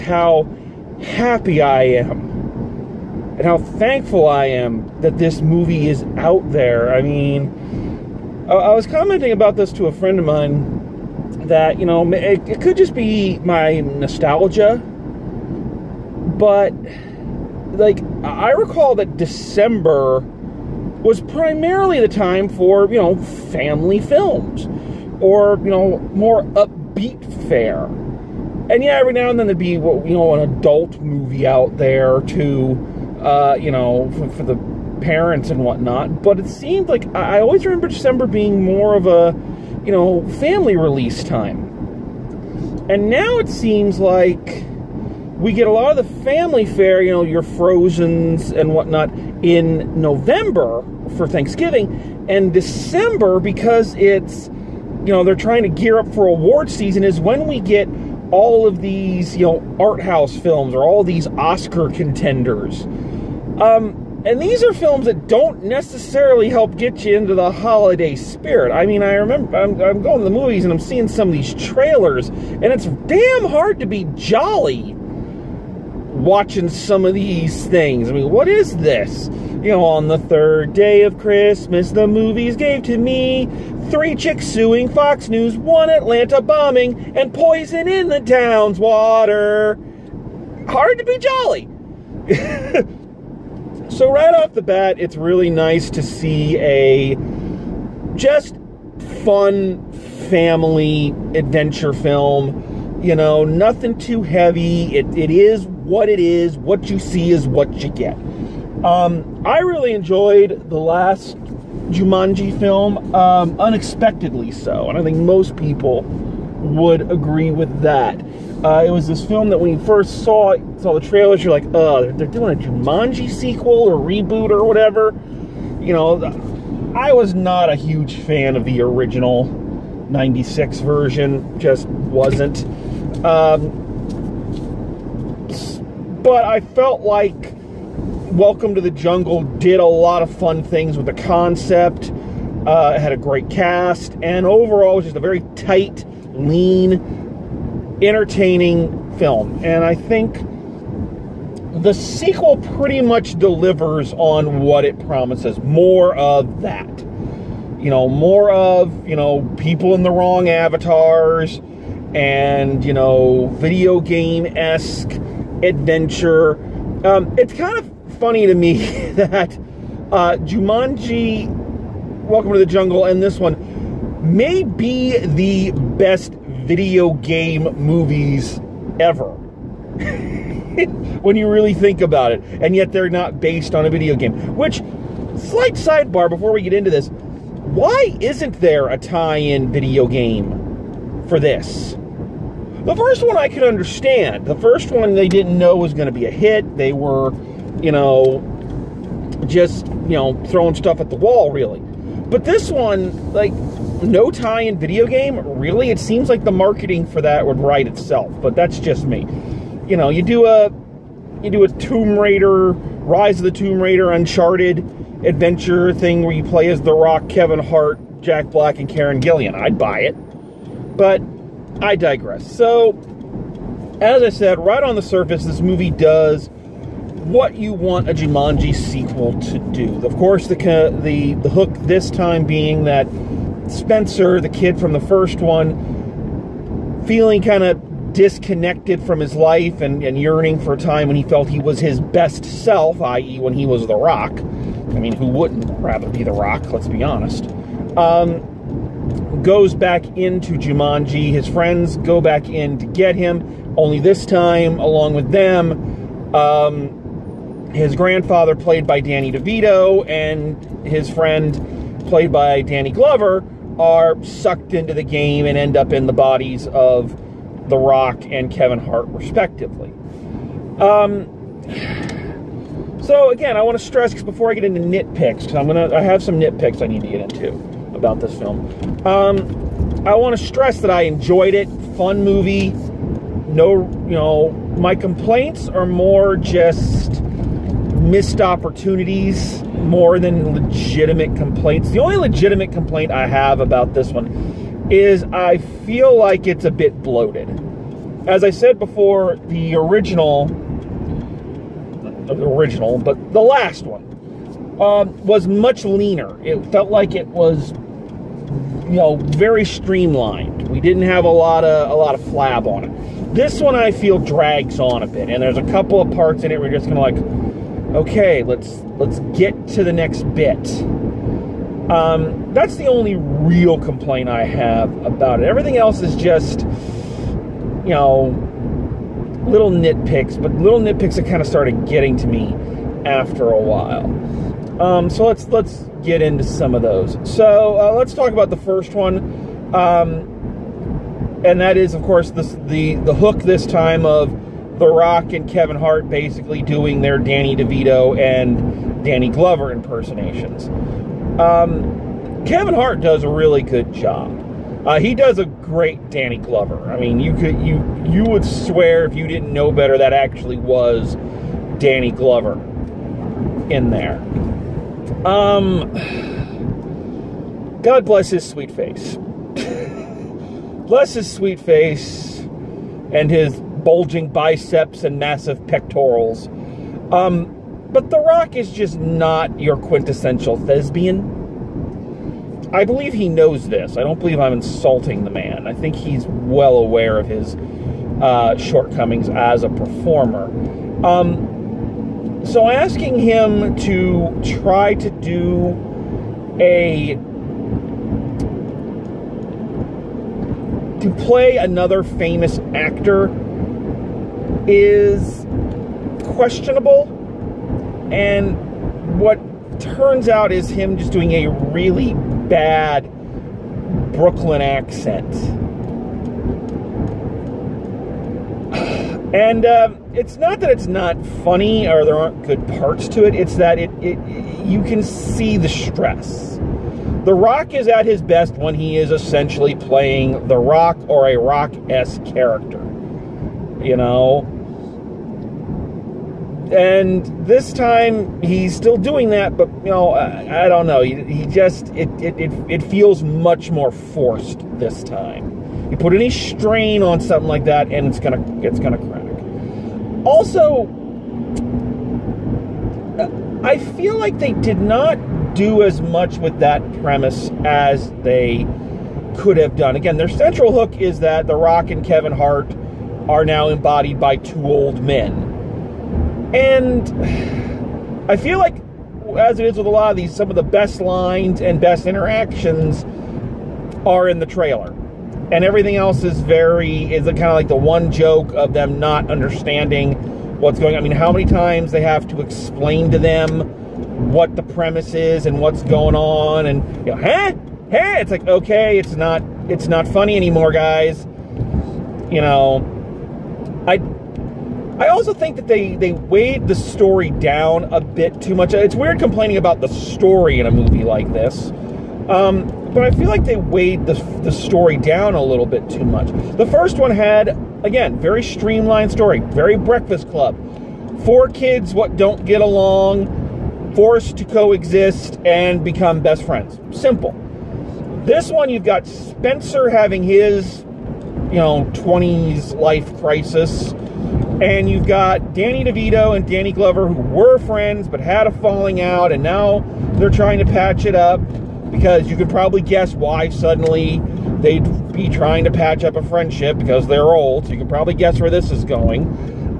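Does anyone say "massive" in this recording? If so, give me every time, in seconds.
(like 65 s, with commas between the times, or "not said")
375 s.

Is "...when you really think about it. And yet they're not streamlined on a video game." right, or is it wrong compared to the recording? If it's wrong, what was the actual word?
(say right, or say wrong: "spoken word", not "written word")
wrong: "based", not "streamlined".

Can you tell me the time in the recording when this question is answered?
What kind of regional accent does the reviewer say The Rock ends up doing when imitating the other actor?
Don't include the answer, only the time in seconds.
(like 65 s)
414 s.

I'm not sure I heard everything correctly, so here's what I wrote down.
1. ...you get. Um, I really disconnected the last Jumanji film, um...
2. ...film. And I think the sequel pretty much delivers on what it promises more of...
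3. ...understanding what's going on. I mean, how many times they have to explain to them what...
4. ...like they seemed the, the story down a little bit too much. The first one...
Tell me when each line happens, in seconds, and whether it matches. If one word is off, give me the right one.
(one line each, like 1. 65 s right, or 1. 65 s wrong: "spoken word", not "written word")
1. 107 s wrong: "enjoyed", not "disconnected"
2. 149 s right
3. 479 s right
4. 503 s wrong: "weighed", not "seemed".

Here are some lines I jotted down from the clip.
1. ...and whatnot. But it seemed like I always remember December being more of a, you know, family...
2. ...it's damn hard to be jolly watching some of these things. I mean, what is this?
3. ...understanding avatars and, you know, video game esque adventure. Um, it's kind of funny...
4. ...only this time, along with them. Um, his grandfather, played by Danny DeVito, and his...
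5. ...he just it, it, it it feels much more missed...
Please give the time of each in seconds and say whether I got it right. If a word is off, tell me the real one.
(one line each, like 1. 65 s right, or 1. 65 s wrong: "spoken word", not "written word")
1. 35 s right
2. 72 s right
3. 160 s wrong: "wrong", not "understanding"
4. 253 s right
5. 441 s wrong: "forced", not "missed".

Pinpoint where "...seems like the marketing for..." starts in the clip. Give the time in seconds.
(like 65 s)
205 s.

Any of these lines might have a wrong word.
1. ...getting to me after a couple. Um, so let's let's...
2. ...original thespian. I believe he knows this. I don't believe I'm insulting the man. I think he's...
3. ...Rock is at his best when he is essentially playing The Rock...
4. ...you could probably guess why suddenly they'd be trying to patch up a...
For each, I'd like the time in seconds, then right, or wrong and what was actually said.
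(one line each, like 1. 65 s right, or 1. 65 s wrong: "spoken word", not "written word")
1. 331 s wrong: "while", not "couple"
2. 379 s wrong: "quintessential", not "original"
3. 427 s right
4. 532 s right.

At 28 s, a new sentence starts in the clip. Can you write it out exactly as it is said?
And yeah, every now and then there'd be, you know, an adult movie out there too.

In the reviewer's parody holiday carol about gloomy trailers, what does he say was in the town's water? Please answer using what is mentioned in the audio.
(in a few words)
Poison.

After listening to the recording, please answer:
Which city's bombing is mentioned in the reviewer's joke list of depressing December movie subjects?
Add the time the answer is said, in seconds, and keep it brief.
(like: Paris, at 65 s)
Atlanta, at 85 s.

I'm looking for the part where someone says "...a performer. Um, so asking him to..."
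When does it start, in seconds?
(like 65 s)
389 s.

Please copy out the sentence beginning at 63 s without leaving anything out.
Um, and these are films that don't necessarily help get you into the holiday spirit.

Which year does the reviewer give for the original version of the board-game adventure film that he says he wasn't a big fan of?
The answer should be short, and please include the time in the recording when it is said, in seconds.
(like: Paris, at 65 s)
1996, at 130 s.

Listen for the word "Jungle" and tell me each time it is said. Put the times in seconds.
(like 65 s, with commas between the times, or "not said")
138 s, 172 s.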